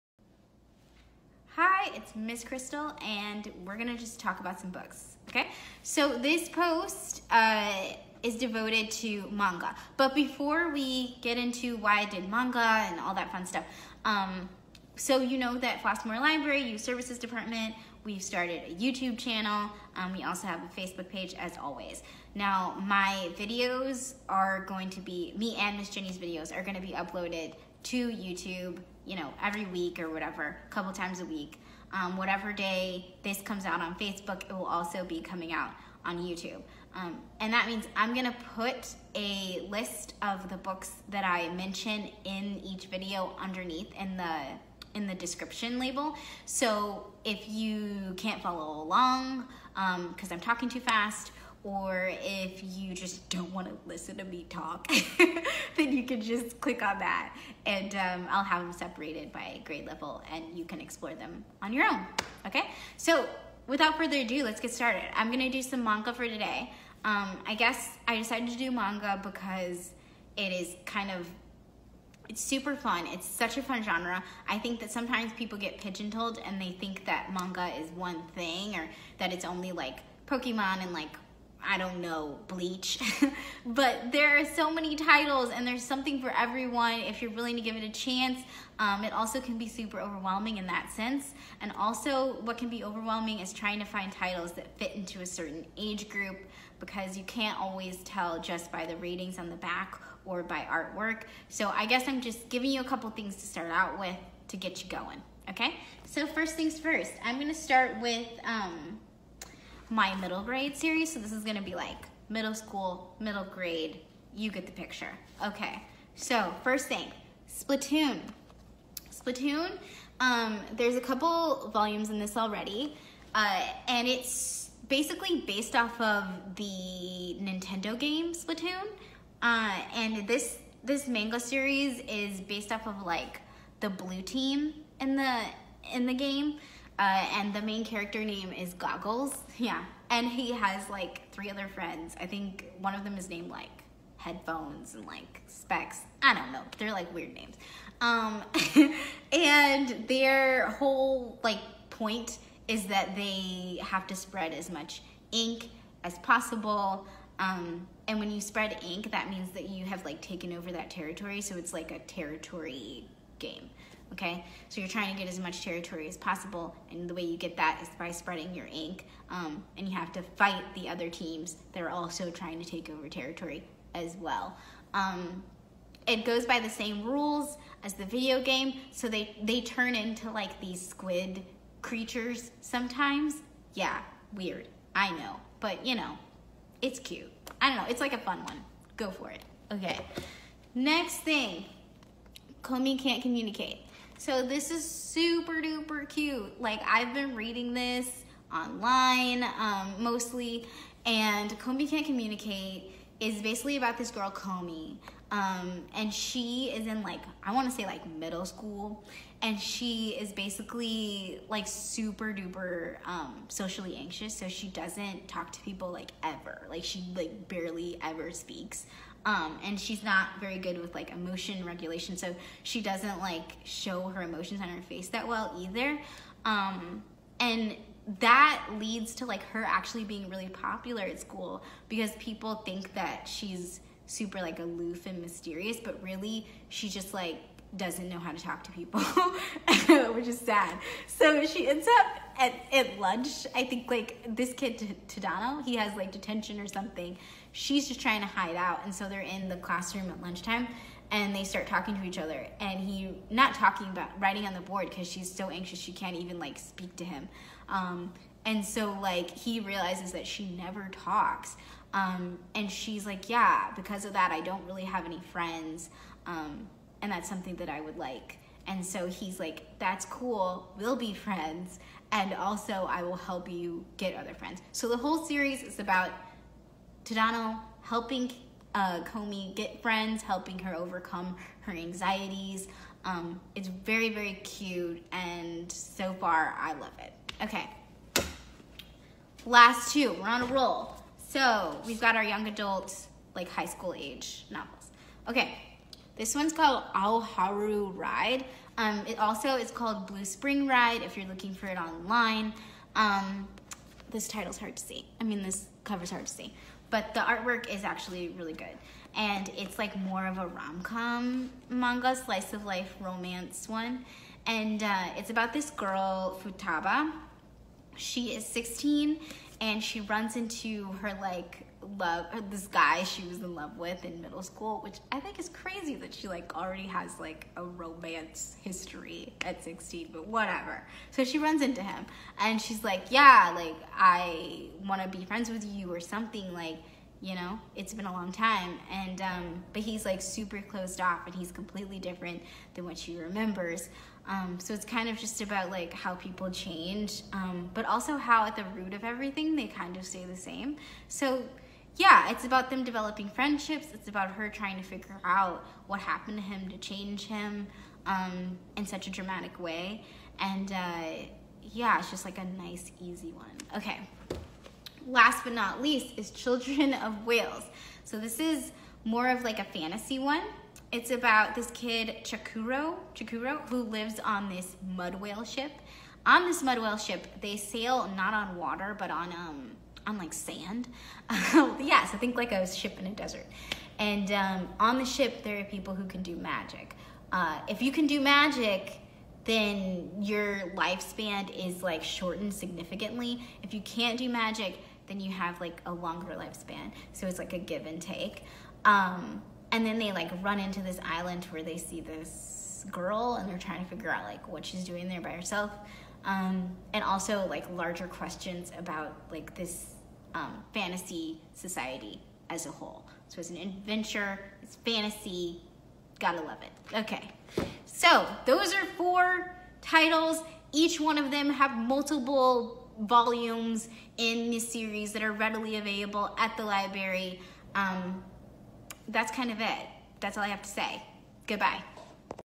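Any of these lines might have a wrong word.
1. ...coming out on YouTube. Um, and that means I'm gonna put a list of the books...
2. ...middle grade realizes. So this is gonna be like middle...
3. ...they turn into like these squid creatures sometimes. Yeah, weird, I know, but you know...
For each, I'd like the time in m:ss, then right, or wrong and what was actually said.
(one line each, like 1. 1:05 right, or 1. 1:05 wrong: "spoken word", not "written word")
1. 0:35 right
2. 1:50 wrong: "series", not "realizes"
3. 2:59 right.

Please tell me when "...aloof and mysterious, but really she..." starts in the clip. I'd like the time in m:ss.
3:54.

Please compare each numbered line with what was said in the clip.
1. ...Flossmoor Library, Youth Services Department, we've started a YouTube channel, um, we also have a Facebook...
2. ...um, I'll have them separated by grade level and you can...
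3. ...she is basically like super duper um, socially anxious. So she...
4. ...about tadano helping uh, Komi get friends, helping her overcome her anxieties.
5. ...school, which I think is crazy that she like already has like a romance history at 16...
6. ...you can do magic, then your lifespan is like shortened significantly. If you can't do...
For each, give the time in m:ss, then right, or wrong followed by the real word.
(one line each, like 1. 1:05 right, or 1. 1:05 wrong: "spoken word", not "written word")
1. 0:15 right
2. 0:57 right
3. 3:29 right
4. 4:35 right
5. 5:24 right
6. 6:27 right.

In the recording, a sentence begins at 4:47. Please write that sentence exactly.
Okay, last two, we're on a roll.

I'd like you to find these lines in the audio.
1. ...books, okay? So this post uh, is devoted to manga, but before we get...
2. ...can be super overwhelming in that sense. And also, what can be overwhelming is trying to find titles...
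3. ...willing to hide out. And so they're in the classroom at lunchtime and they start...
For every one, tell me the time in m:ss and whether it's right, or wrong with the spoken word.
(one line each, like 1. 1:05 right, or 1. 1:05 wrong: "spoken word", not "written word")
1. 0:04 right
2. 1:29 right
3. 4:08 wrong: "trying", not "willing".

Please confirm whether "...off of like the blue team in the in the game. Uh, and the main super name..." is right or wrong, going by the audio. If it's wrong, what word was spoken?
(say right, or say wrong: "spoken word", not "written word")
wrong: "character", not "super".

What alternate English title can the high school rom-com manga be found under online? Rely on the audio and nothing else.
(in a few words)
Blue Spring Ride.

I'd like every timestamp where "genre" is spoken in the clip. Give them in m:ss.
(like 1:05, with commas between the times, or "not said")
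1:13.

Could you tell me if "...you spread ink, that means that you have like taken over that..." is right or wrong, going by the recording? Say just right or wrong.
right.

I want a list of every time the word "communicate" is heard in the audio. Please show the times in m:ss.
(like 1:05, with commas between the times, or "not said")
3:13, 3:22.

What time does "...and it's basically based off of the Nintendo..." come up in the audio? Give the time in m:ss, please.
2:03.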